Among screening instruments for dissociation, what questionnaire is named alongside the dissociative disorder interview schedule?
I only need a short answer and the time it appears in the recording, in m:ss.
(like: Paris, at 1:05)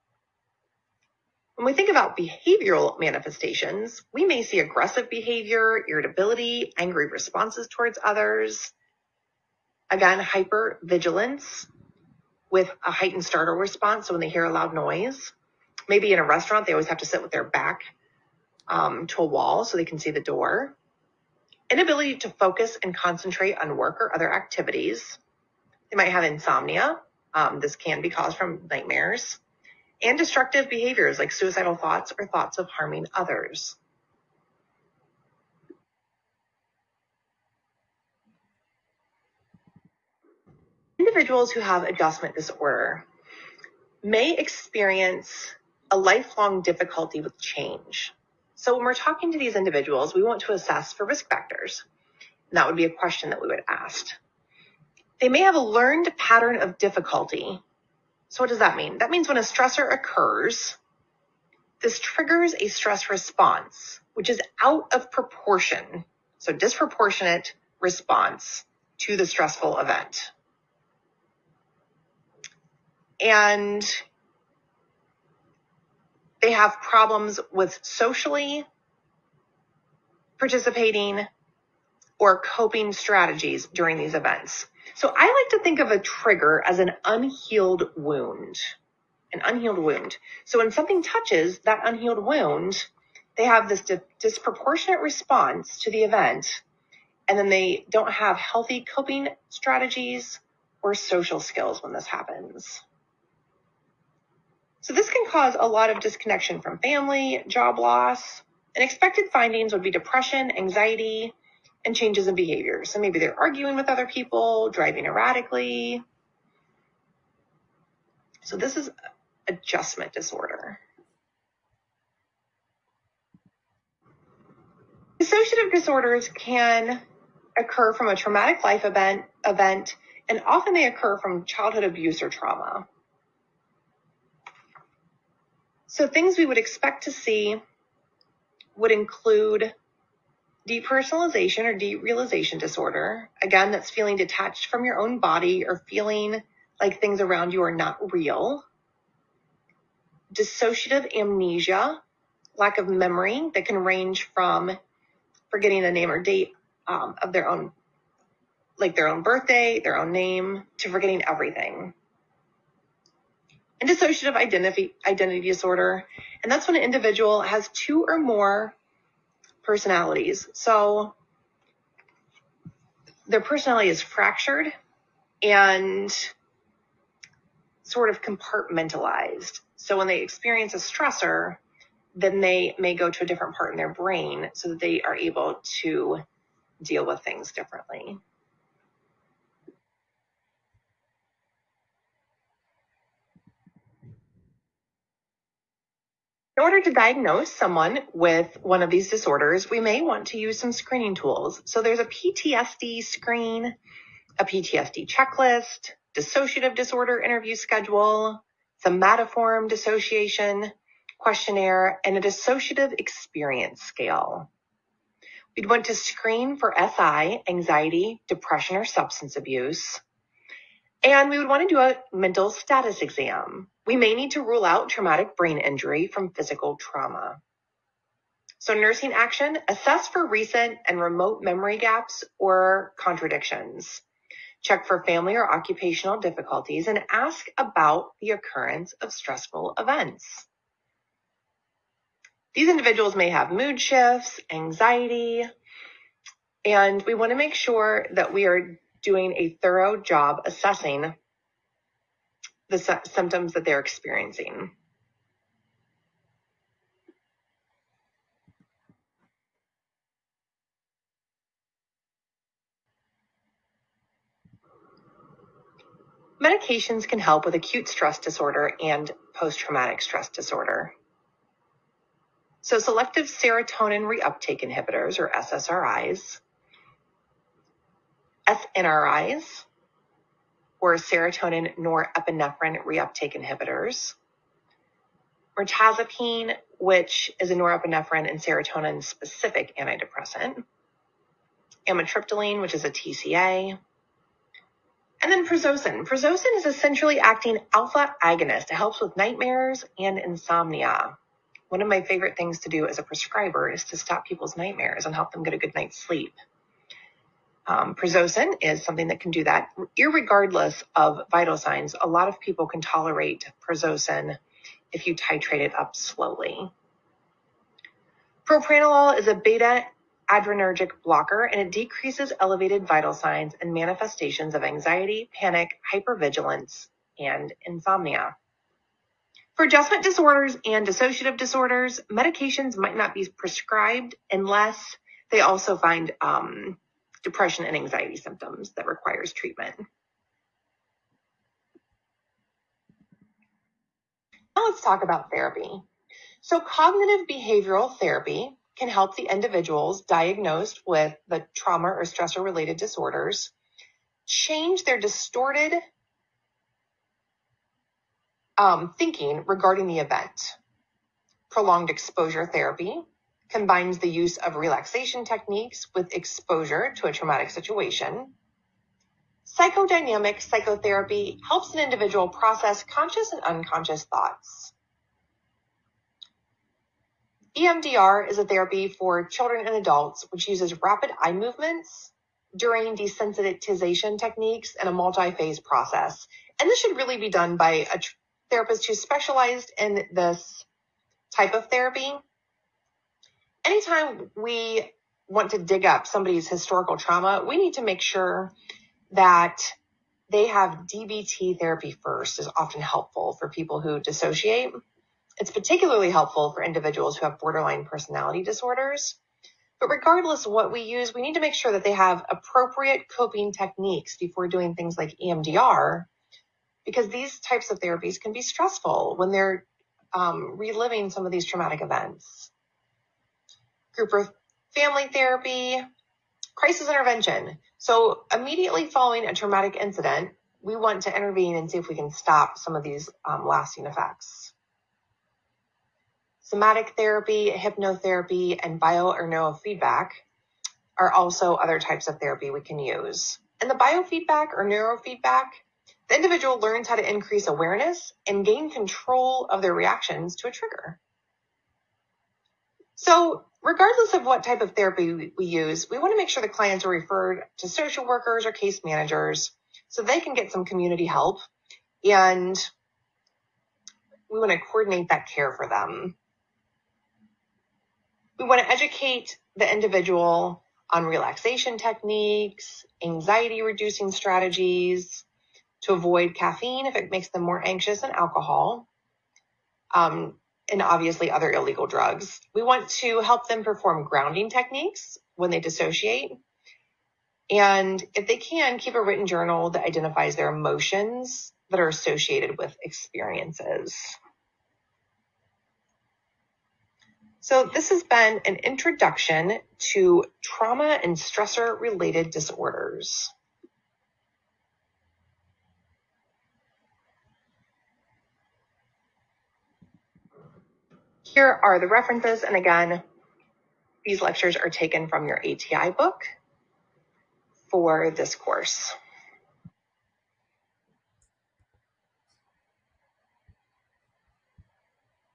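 somatoform dissociation questionnaire, at 3:28.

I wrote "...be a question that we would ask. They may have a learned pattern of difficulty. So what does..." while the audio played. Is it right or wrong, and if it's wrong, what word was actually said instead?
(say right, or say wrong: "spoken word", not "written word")
right.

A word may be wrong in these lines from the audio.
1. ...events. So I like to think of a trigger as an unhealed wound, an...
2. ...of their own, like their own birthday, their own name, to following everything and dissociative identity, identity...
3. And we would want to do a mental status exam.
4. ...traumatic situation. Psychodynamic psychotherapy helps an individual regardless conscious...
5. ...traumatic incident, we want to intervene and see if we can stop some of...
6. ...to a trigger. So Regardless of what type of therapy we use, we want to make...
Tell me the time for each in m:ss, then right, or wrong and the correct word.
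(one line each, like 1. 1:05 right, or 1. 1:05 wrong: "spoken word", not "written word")
1. 1:24 right
2. 2:37 wrong: "forgetting", not "following"
3. 3:41 right
4. 6:07 wrong: "process", not "regardless"
5. 7:09 right
6. 7:30 right.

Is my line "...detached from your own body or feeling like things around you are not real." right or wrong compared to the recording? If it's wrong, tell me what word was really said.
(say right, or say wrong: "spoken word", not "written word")
right.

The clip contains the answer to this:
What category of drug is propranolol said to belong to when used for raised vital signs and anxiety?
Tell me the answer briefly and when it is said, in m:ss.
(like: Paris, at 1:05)
beta adrenergic blocker, at 5:19.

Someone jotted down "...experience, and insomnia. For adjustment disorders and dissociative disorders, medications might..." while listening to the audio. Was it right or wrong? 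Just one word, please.
wrong.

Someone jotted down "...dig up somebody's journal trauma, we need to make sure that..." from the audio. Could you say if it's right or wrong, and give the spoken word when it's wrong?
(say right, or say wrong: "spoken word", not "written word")
wrong: "historical", not "journal".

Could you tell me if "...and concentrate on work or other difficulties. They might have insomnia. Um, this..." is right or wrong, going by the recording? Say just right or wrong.
wrong.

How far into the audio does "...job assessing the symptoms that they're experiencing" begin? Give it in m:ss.
4:09.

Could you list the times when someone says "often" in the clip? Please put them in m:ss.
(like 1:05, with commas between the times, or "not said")
2:10, 6:42.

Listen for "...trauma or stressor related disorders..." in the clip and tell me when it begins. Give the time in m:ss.
5:51.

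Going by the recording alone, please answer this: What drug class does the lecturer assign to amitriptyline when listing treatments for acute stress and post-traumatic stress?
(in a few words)
TCA.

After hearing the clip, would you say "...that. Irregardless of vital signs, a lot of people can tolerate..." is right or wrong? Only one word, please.
right.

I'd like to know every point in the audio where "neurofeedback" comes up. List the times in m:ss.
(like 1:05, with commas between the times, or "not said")
7:19, 7:24.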